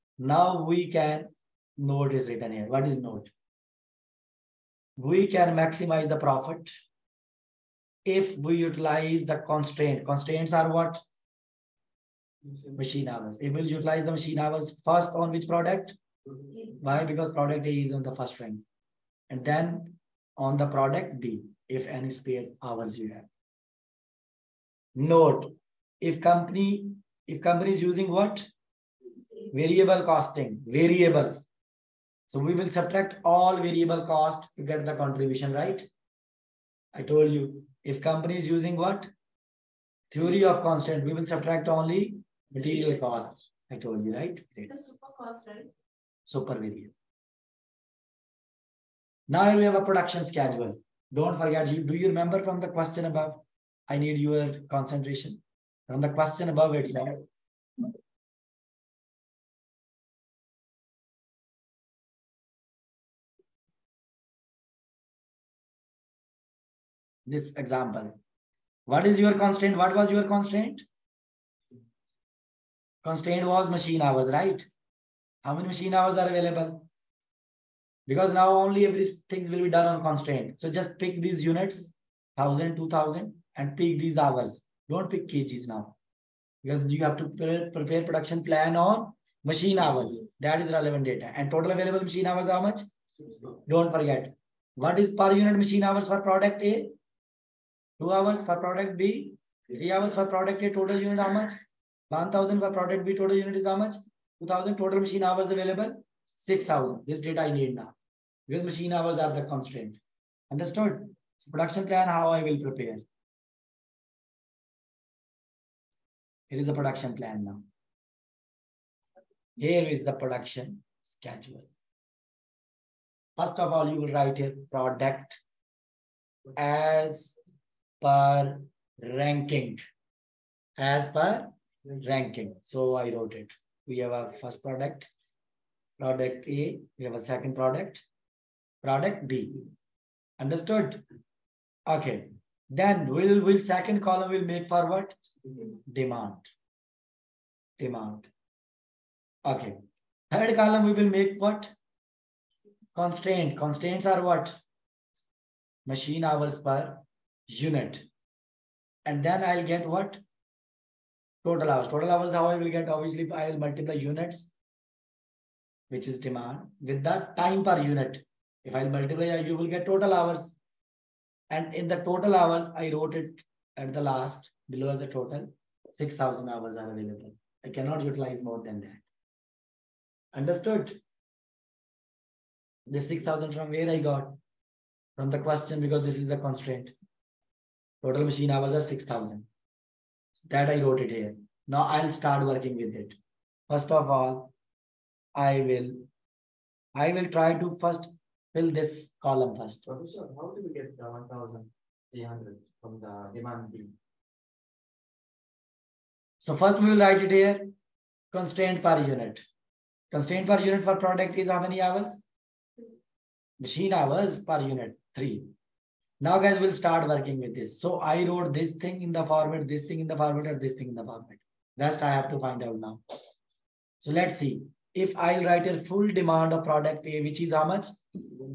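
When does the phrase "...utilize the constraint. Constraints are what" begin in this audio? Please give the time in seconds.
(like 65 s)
8 s.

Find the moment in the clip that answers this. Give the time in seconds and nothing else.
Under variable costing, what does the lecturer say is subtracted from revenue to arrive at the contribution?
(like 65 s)
33 s.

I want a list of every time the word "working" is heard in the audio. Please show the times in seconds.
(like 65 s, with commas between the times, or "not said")
192 s, 217 s.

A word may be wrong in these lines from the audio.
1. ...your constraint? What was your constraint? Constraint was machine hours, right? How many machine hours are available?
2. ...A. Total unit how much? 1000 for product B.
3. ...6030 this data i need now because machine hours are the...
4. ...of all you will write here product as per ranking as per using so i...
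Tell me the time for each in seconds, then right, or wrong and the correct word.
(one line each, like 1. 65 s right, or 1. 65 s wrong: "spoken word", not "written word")
1. 69 s right
2. 100 s right
3. 106 s wrong: "6000", not "6030"
4. 123 s wrong: "ranking", not "using".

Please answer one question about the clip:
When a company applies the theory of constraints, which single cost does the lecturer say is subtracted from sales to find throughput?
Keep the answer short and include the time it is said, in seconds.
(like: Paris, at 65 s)
Material cost, at 42 s.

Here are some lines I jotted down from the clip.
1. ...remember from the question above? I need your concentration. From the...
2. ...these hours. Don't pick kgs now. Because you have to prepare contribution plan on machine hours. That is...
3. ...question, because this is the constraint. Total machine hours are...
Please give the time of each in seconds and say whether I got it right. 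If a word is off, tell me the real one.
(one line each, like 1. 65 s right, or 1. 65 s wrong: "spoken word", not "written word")
1. 52 s right
2. 83 s wrong: "production", not "contribution"
3. 185 s right.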